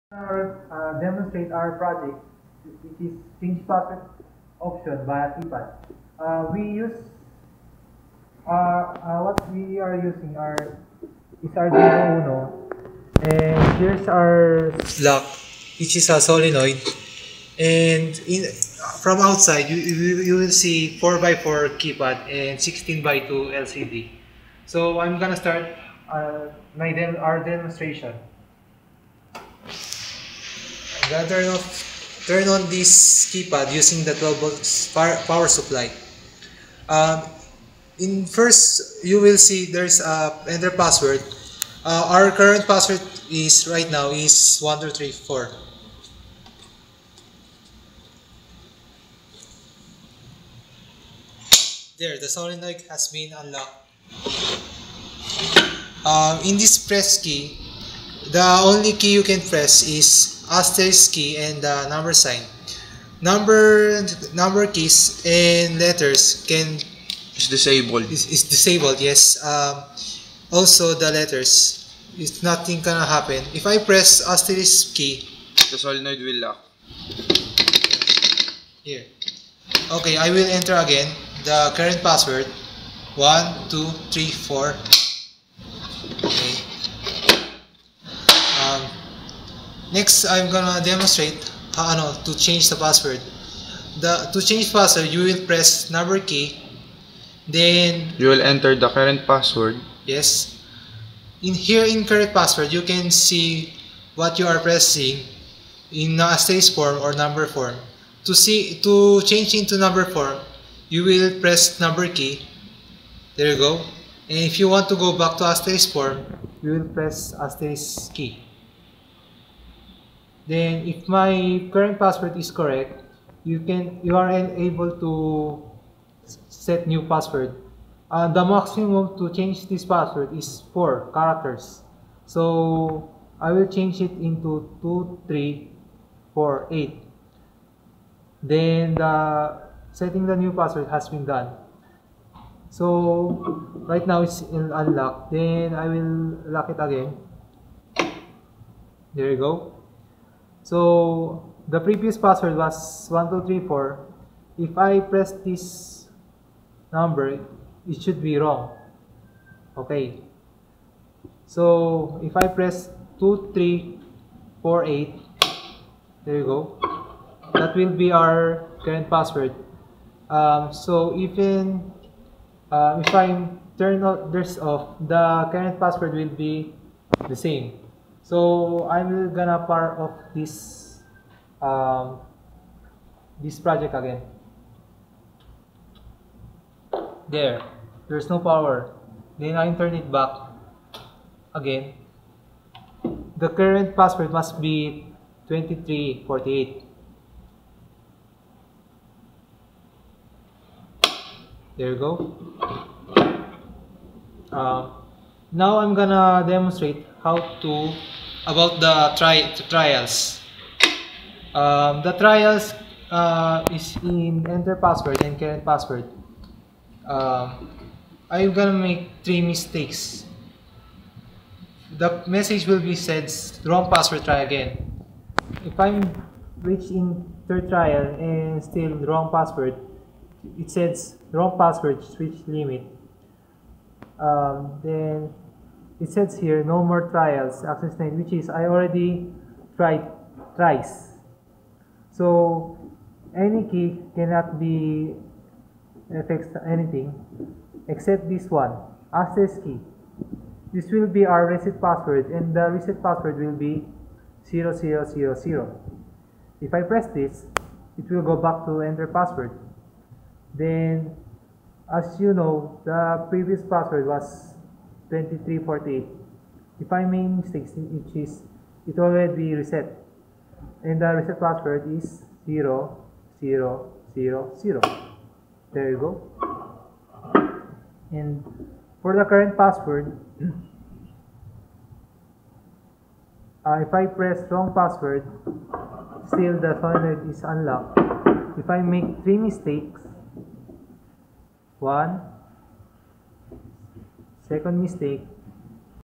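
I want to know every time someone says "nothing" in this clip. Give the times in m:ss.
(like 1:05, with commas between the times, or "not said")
1:12.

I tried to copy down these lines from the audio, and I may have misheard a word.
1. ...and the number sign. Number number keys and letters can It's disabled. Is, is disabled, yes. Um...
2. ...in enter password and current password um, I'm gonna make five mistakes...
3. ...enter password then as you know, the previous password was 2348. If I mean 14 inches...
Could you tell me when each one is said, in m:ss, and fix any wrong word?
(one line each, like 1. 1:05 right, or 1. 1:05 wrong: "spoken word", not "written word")
1. 1:01 right
2. 3:33 wrong: "three", not "five"
3. 4:18 wrong: "16", not "14".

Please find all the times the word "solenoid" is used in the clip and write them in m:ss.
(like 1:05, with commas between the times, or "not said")
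0:16, 0:52, 1:15.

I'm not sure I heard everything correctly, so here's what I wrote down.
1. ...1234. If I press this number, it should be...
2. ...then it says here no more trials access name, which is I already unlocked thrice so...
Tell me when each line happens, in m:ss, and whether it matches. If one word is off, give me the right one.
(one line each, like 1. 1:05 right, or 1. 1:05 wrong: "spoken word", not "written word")
1. 2:33 right
2. 3:54 wrong: "tried", not "unlocked".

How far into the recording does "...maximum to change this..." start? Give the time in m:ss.
2:08.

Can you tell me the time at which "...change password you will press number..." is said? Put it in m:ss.
1:34.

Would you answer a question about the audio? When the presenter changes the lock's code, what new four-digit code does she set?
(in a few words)
2348.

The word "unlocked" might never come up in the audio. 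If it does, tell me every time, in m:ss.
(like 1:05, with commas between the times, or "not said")
0:53, 2:24, 4:47.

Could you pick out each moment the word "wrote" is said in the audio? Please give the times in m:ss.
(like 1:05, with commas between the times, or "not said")
not said.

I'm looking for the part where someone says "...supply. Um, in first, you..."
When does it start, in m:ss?
0:35.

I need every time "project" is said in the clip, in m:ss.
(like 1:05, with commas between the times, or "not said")
0:01, 3:03.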